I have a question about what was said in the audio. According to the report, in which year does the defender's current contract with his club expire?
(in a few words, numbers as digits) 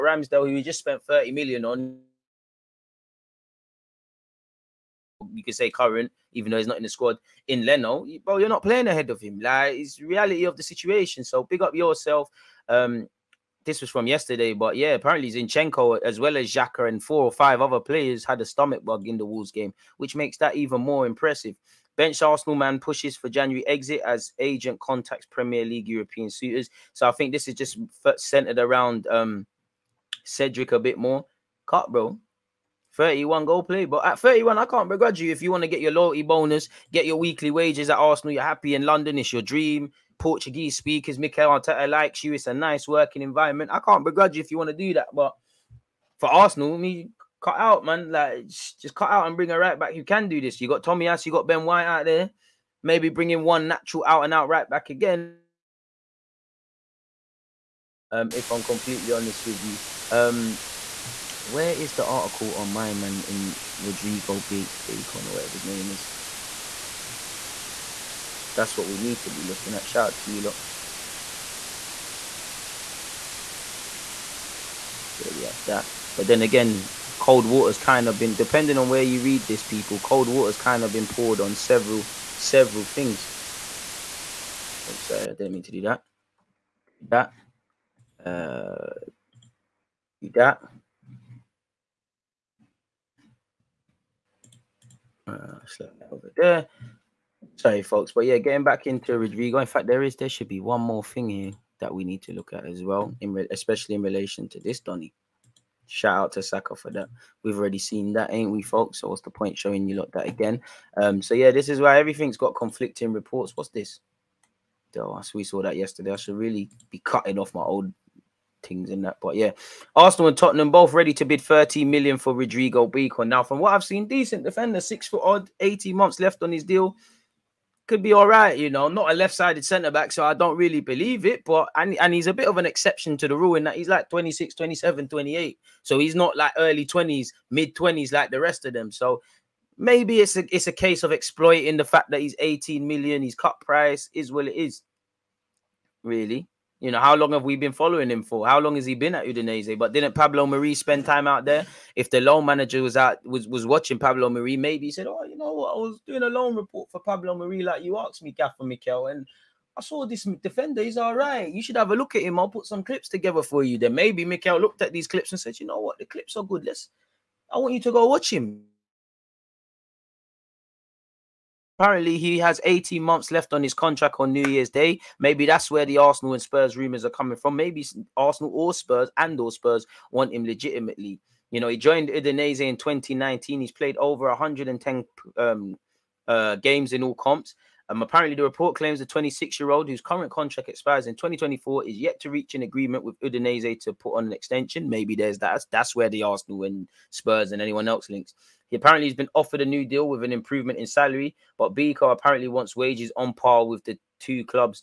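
2024.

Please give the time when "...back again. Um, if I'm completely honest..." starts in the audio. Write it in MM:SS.
00:54.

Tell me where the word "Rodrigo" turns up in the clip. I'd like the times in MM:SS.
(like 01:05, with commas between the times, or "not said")
01:03, 01:39, 02:02.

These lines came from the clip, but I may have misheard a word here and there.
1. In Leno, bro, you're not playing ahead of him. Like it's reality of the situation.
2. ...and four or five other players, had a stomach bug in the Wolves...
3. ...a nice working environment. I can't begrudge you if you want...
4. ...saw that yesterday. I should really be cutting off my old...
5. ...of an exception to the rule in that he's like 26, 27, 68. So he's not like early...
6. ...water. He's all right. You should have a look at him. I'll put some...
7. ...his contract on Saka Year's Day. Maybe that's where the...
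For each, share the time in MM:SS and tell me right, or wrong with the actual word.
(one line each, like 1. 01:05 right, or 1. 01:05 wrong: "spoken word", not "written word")
1. 00:07 right
2. 00:16 right
3. 00:42 right
4. 01:55 right
5. 02:12 wrong: "28", not "68"
6. 02:40 wrong: "defender", not "water"
7. 02:53 wrong: "New", not "Saka".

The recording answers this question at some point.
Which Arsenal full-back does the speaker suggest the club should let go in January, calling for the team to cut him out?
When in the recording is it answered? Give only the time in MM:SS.
00:30.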